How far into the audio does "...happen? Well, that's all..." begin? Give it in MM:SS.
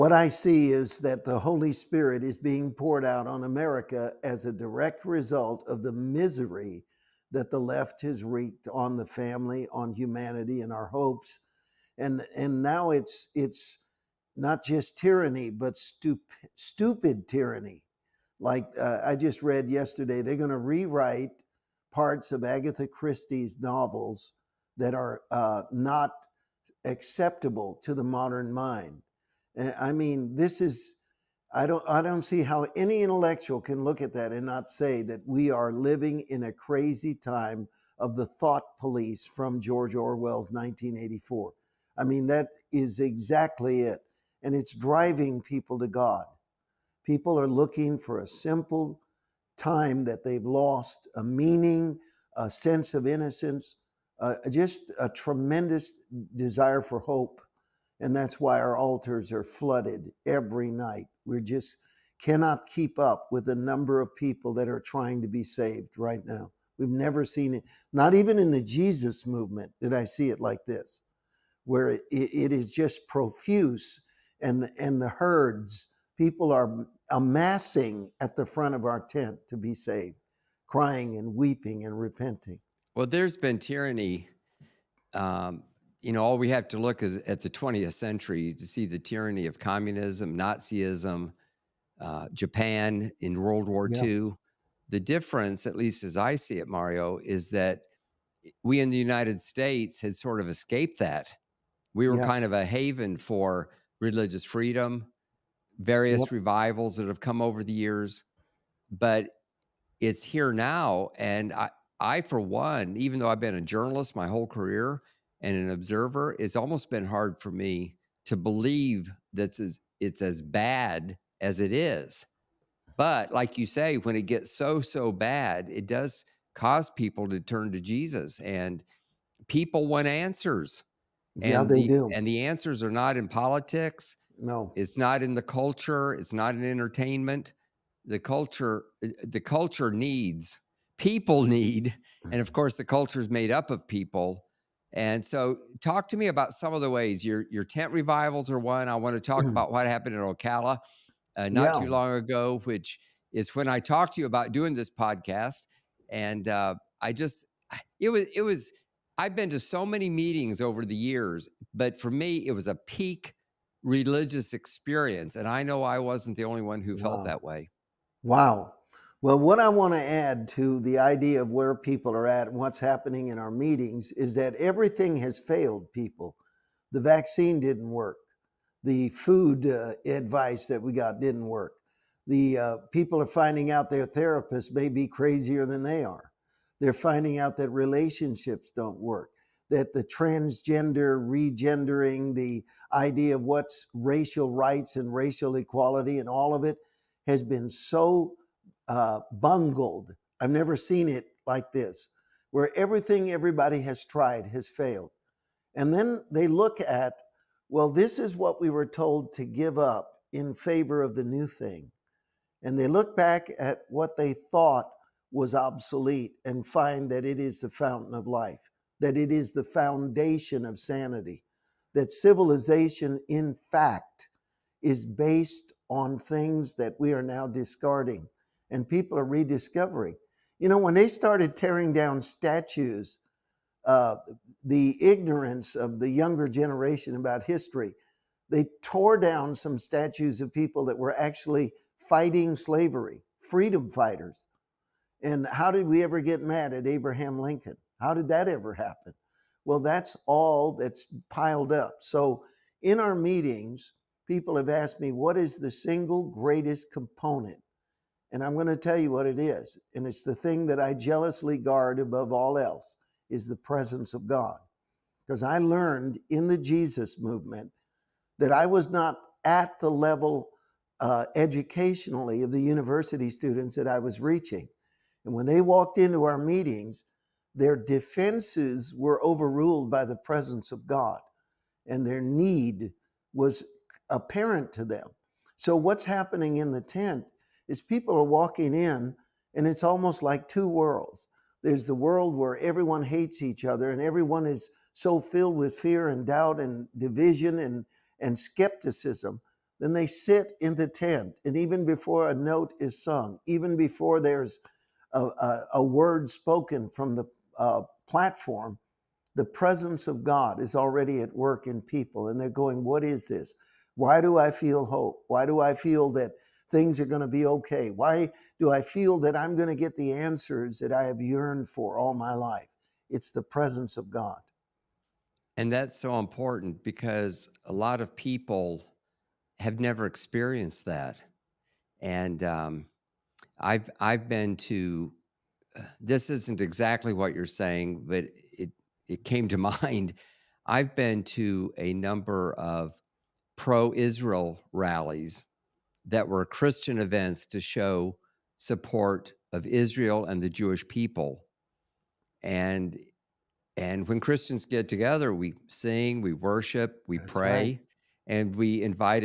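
04:08.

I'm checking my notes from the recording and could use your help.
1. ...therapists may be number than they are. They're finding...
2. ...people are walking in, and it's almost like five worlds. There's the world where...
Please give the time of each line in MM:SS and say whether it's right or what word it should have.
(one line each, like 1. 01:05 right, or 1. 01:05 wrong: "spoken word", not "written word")
1. 03:04 wrong: "crazier", not "number"
2. 04:47 wrong: "two", not "five".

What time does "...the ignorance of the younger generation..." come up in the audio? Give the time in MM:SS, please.
03:54.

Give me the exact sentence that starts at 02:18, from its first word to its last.
The culture, eh, the culture needs people need, and of mm-hmm.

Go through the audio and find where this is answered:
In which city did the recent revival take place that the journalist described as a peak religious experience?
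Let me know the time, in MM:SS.
02:30.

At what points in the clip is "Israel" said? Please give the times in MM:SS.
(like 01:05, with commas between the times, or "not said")
05:43, 05:49.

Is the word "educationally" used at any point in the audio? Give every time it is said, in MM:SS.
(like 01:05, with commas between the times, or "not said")
04:31.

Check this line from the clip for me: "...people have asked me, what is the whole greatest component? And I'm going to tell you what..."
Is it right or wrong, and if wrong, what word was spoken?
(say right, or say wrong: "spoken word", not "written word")
wrong: "single", not "whole".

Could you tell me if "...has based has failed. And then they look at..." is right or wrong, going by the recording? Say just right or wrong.
wrong.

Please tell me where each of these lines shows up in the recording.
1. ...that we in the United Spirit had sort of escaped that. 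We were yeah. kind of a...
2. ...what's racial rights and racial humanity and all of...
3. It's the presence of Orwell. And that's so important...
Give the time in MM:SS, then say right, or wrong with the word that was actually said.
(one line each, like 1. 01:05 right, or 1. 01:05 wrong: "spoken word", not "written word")
1. 01:37 wrong: "States", not "Spirit"
2. 03:13 wrong: "equality", not "humanity"
3. 05:23 wrong: "God", not "Orwell".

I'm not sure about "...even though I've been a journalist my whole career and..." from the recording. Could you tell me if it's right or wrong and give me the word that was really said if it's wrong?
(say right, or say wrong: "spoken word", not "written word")
right.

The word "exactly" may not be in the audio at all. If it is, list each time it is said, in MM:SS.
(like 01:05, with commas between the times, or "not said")
00:42, 05:36.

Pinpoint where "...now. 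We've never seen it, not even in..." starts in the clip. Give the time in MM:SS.
01:06.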